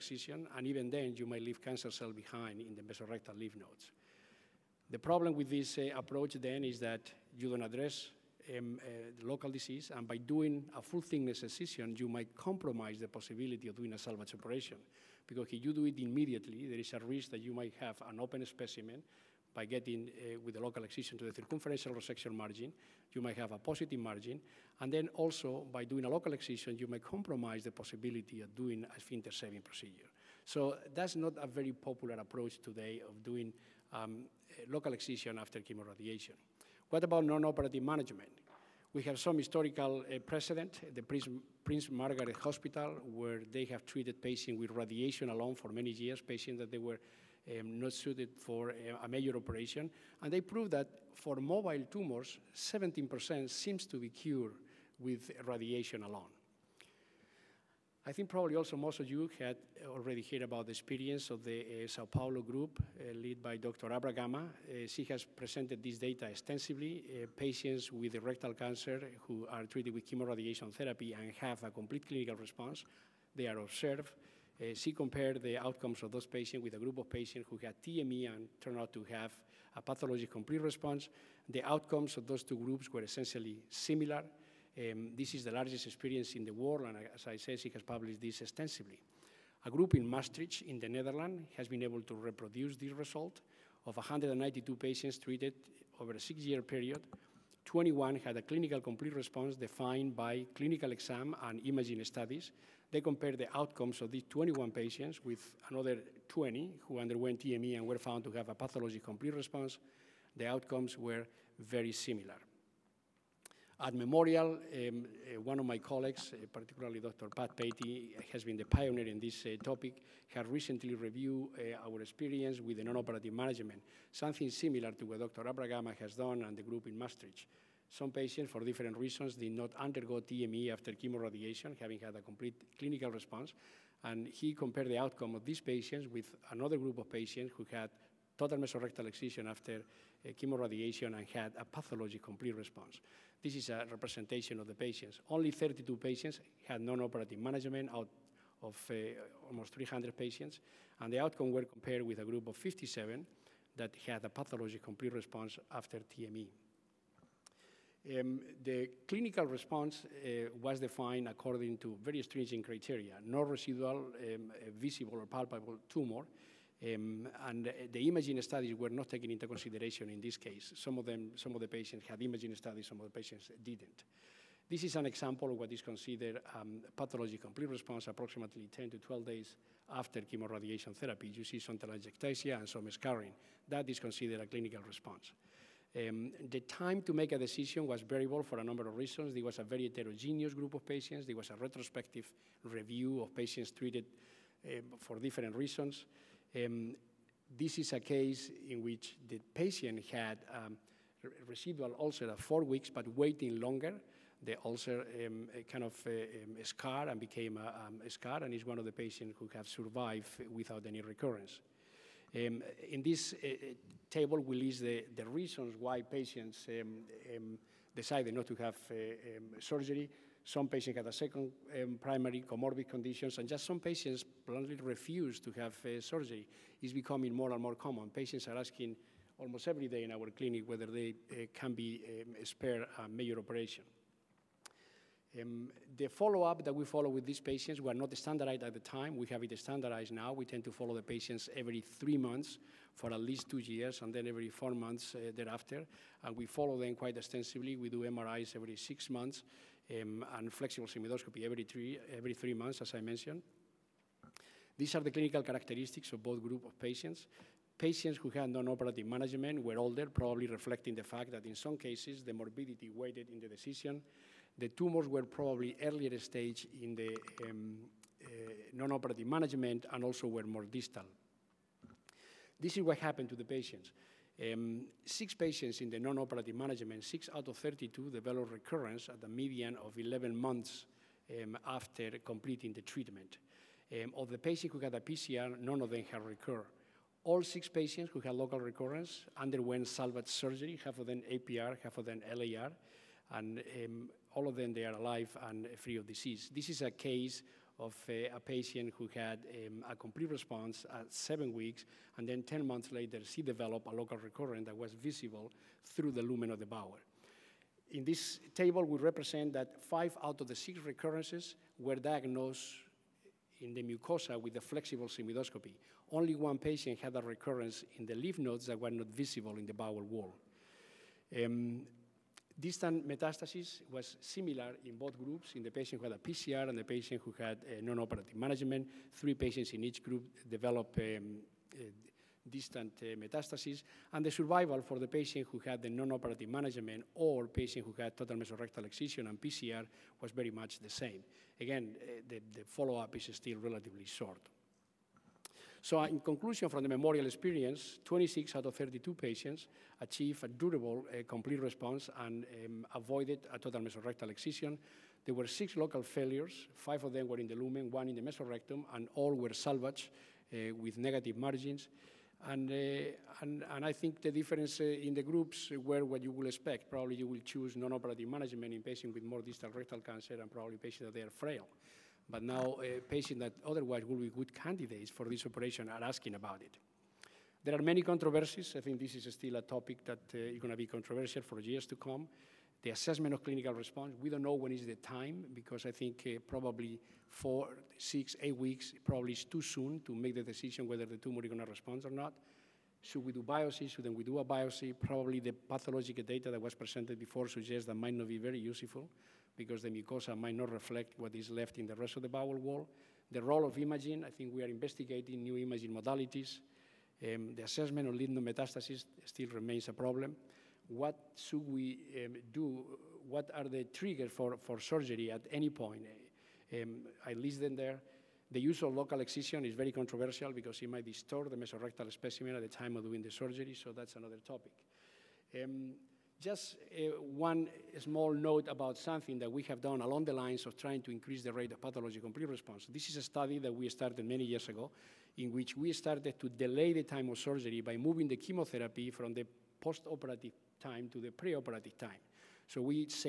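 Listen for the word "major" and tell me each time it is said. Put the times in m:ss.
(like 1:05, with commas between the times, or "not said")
0:49, 3:53.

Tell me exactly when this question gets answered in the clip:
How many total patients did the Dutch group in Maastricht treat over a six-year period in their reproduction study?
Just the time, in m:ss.
1:33.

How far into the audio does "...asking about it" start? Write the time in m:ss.
6:16.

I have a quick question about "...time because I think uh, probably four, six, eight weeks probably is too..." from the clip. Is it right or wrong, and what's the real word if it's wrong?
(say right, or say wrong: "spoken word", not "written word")
right.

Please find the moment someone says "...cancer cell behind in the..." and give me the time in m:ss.
0:01.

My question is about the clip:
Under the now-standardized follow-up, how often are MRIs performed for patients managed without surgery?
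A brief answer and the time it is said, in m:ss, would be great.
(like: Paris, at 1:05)
every six months, at 4:08.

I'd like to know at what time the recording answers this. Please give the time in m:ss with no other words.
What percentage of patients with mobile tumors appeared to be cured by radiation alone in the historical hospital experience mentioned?
0:52.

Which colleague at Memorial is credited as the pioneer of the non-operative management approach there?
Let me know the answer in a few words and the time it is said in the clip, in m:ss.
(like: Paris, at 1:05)
Dr. Pat Paty, at 1:56.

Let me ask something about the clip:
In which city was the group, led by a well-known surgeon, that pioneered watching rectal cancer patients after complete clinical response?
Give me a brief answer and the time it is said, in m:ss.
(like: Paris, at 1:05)
Sao Paulo, at 1:01.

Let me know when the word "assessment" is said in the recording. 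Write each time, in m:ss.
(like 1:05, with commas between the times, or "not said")
6:22, 6:47.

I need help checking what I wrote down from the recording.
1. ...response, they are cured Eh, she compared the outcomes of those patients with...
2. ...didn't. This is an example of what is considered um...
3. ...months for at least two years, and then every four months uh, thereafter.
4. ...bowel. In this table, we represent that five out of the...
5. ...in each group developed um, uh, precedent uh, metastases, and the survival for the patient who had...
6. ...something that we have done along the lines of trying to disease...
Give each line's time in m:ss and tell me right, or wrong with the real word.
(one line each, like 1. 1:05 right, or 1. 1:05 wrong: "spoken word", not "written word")
1. 1:12 wrong: "observed", not "cured"
2. 2:53 right
3. 4:02 right
4. 5:06 right
5. 5:29 wrong: "distant", not "precedent"
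6. 7:08 wrong: "increase", not "disease".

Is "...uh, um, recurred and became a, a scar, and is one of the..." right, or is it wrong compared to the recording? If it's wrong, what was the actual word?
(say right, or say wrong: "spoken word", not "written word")
wrong: "scarred", not "recurred".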